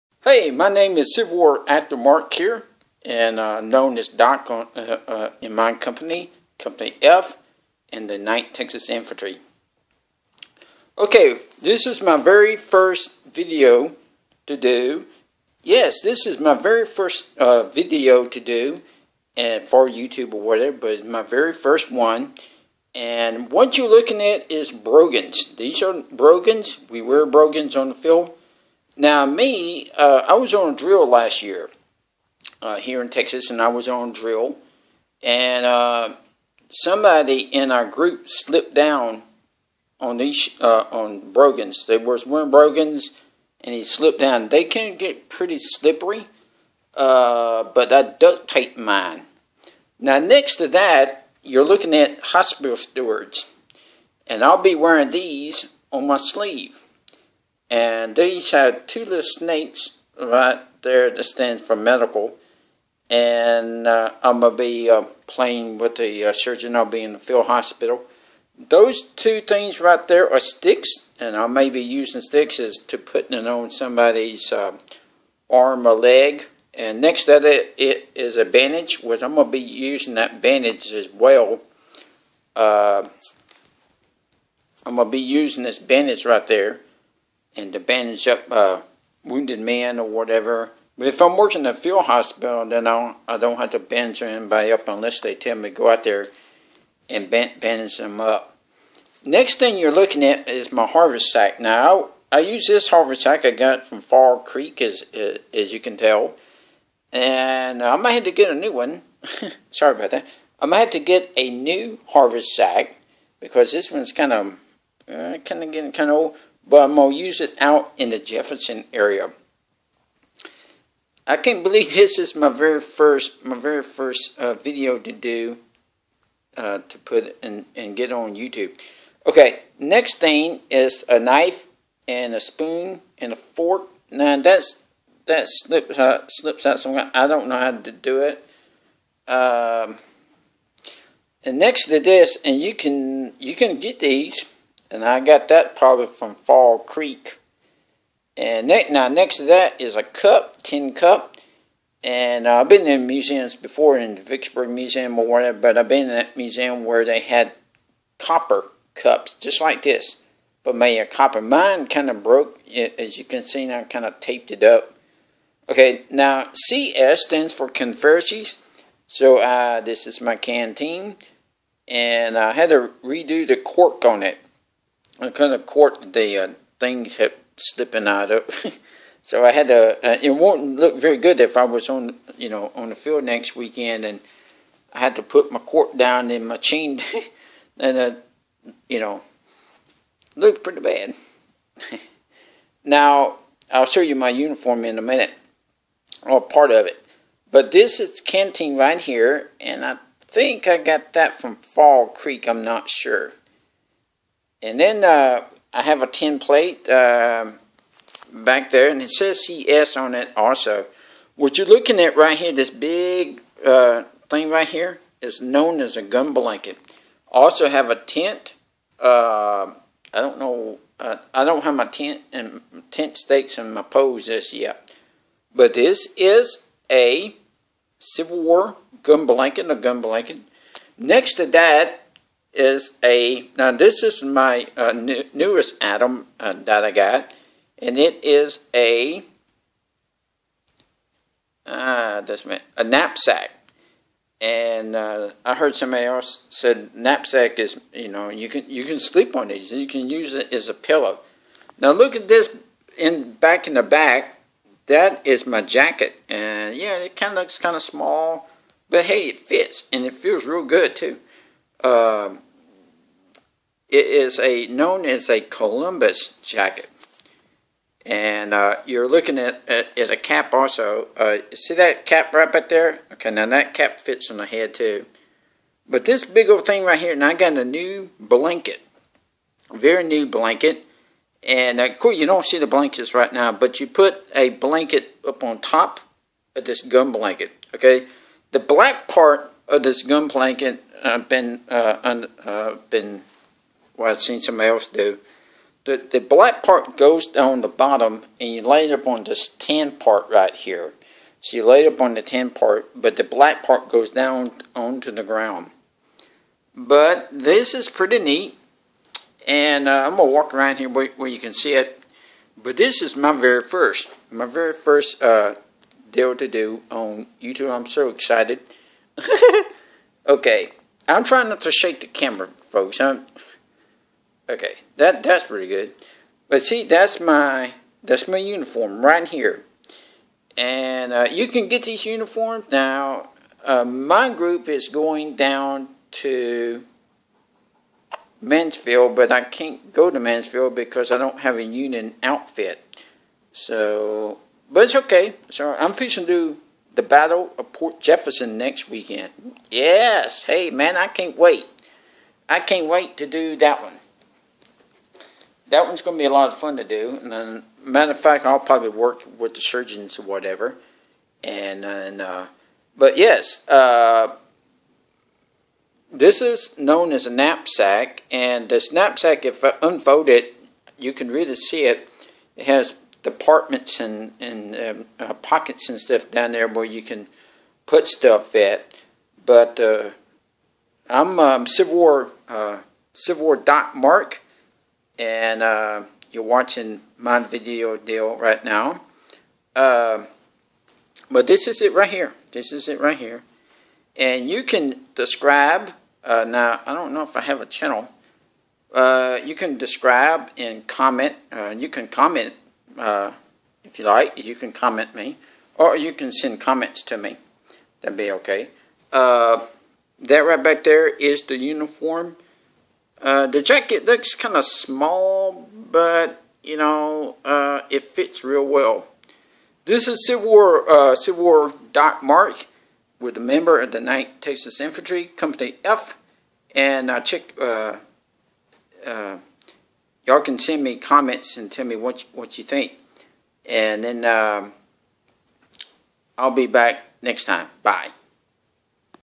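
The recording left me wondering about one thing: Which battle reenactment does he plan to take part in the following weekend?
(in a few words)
Battle of Port Jefferson.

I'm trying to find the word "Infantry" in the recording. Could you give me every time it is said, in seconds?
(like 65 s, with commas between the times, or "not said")
8 s, 424 s.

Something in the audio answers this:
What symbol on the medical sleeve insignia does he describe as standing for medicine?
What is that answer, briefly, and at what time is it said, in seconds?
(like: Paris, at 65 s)
two little snakes, at 58 s.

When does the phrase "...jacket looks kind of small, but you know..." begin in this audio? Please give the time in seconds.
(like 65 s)
413 s.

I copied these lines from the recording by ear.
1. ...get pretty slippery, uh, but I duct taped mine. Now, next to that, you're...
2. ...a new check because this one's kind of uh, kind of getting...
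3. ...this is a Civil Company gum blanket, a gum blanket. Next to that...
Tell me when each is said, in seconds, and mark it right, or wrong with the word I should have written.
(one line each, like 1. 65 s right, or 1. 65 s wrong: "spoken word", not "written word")
1. 44 s right
2. 111 s wrong: "haversack", not "check"
3. 225 s wrong: "War", not "Company".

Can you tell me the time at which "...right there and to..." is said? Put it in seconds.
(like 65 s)
86 s.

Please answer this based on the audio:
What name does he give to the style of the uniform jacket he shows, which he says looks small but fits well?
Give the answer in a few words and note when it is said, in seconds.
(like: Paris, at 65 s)
Columbus jacket, at 265 s.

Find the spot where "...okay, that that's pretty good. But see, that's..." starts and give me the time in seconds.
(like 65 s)
324 s.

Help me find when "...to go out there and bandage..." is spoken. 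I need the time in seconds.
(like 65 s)
95 s.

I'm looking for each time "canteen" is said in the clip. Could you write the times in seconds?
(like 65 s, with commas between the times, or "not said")
170 s, 198 s.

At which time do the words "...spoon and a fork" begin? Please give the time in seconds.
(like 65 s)
132 s.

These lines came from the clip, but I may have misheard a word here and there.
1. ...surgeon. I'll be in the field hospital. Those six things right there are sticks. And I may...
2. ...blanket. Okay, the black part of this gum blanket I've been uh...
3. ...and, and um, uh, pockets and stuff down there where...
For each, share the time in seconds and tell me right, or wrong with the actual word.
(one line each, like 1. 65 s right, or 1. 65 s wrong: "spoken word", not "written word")
1. 66 s wrong: "two", not "six"
2. 287 s right
3. 373 s right.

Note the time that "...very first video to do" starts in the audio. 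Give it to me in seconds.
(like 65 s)
12 s.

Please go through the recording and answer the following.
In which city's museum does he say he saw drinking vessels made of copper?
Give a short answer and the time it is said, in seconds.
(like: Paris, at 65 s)
Vicksburg, at 154 s.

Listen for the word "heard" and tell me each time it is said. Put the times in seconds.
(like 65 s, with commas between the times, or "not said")
245 s.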